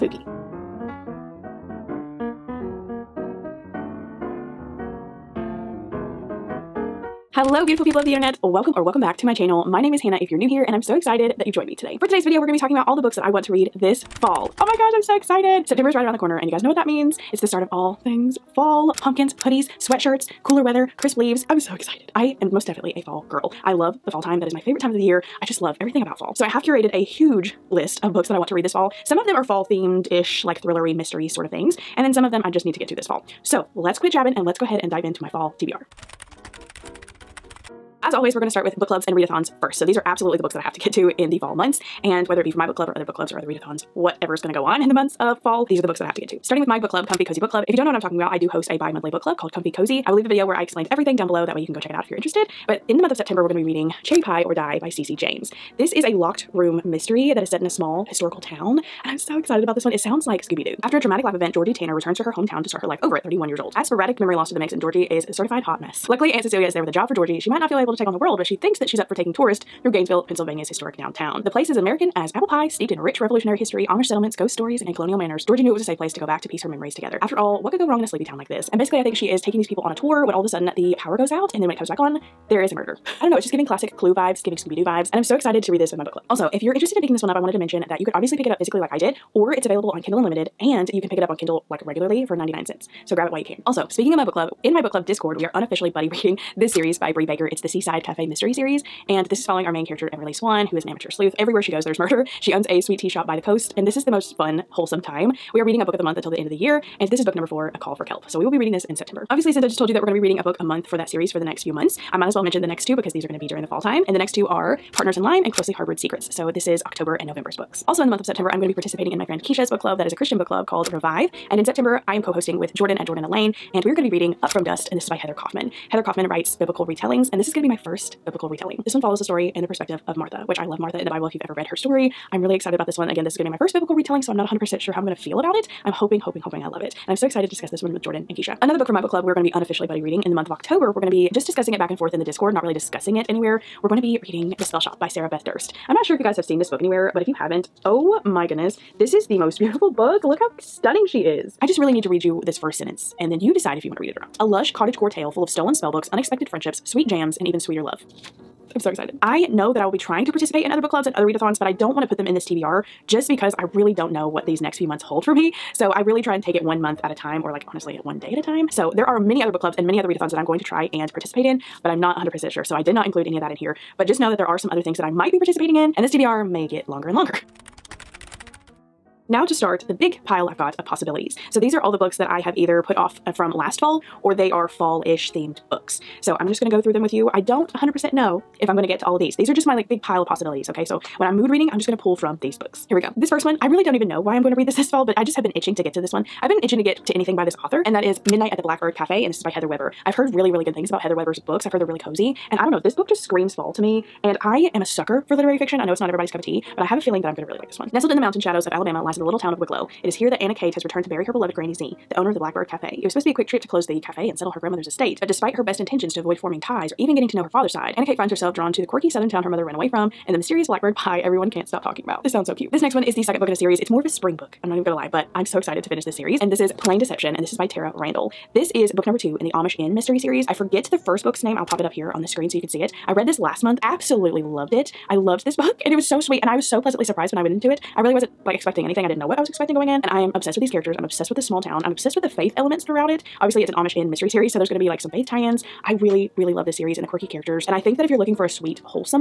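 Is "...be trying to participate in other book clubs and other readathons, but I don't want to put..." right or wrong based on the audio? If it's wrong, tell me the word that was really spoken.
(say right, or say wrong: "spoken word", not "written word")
right.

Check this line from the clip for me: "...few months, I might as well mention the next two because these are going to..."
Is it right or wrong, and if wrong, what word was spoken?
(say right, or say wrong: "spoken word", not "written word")
right.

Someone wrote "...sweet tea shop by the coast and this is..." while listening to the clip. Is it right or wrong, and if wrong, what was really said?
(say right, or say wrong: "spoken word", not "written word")
right.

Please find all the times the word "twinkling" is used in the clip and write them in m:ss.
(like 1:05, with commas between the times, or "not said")
not said.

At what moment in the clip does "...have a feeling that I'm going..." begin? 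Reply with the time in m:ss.
3:26.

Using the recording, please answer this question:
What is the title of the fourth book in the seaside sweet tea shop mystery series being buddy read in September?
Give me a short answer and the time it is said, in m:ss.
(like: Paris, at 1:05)
A Call for Kelp, at 1:47.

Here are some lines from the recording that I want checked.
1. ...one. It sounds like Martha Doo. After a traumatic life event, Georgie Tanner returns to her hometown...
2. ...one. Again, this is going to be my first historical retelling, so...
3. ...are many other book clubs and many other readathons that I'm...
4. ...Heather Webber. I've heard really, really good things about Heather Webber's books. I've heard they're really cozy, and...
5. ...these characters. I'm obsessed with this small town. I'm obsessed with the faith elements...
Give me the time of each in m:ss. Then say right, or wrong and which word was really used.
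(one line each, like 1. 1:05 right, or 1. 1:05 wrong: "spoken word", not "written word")
1. 0:59 wrong: "Scooby", not "Martha"
2. 2:12 wrong: "biblical", not "historical"
3. 2:49 right
4. 3:19 right
5. 4:00 right.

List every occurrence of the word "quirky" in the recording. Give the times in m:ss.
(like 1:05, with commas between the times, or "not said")
3:38, 4:07.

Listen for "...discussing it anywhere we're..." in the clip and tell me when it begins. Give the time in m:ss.
2:22.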